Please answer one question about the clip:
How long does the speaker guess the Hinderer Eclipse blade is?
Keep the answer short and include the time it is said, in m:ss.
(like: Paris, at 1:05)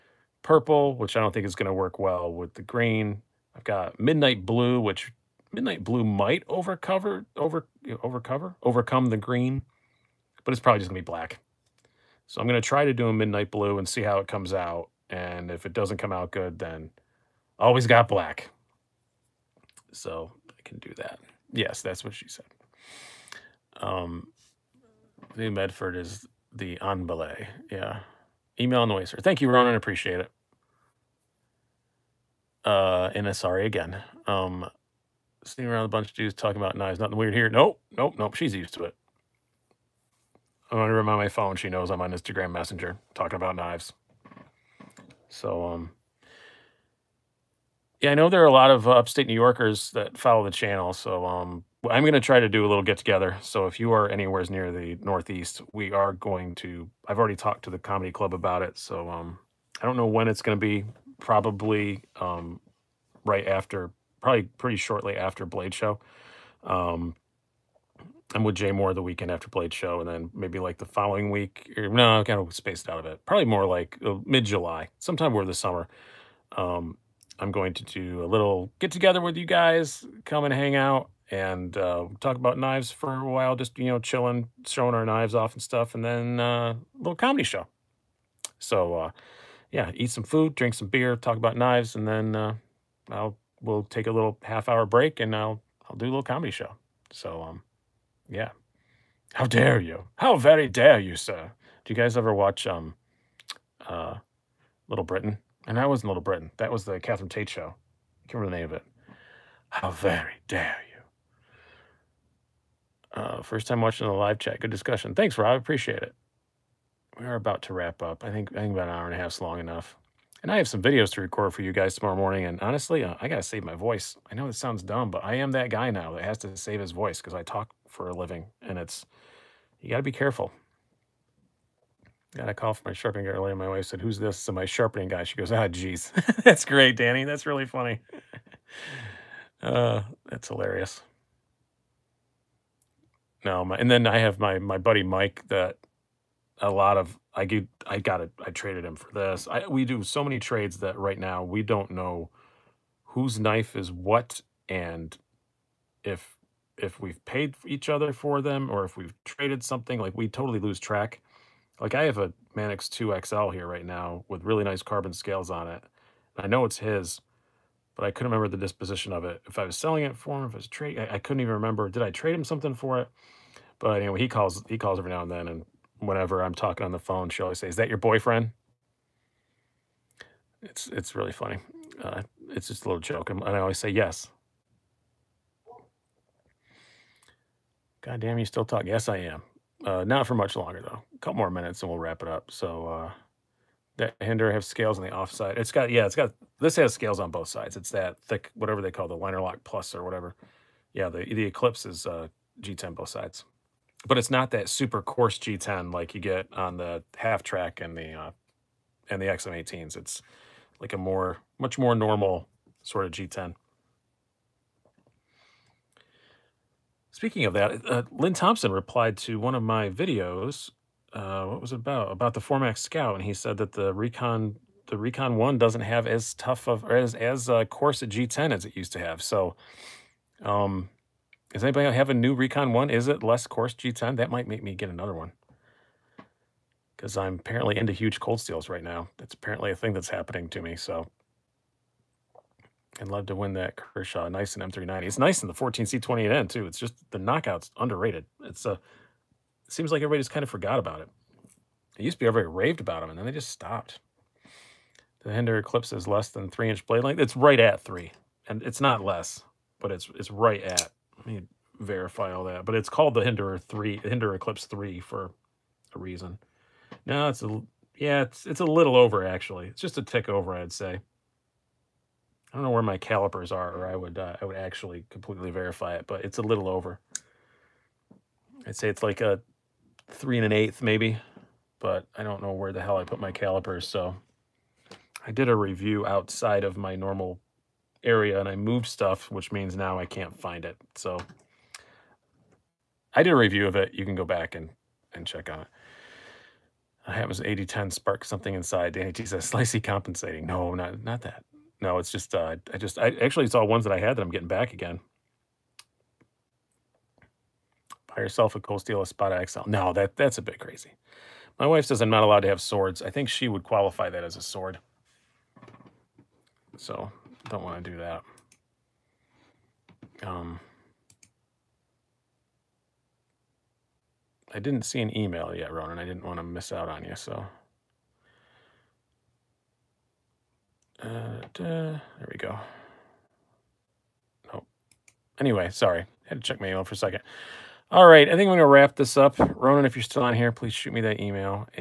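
3 1/8 inches, at 4:40.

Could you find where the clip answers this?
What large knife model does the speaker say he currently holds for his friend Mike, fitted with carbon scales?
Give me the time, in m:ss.
2:42.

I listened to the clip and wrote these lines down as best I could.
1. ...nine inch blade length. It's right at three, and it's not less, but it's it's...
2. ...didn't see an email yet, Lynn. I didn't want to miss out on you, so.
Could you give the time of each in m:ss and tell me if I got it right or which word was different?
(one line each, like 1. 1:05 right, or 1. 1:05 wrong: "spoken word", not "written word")
1. 4:16 wrong: "three", not "nine"
2. 5:24 wrong: "Ronan", not "Lynn".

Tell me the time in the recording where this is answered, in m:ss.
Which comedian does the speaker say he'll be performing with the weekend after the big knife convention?
1:08.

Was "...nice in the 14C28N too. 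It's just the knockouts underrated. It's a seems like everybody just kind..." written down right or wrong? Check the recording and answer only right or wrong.
right.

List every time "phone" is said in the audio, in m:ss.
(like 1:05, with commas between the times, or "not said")
0:41, 2:56.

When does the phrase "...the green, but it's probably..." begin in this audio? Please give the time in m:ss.
0:09.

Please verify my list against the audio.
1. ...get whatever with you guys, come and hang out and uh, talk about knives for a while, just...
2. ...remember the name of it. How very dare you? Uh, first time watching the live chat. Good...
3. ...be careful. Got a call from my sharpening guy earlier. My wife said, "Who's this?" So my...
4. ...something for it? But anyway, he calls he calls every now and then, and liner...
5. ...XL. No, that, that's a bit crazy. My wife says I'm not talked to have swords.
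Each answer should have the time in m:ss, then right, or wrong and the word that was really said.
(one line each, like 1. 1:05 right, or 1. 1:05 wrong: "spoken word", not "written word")
1. 1:18 wrong: "together", not "whatever"
2. 1:48 right
3. 2:10 right
4. 2:52 wrong: "whenever", not "liner"
5. 5:09 wrong: "allowed", not "talked".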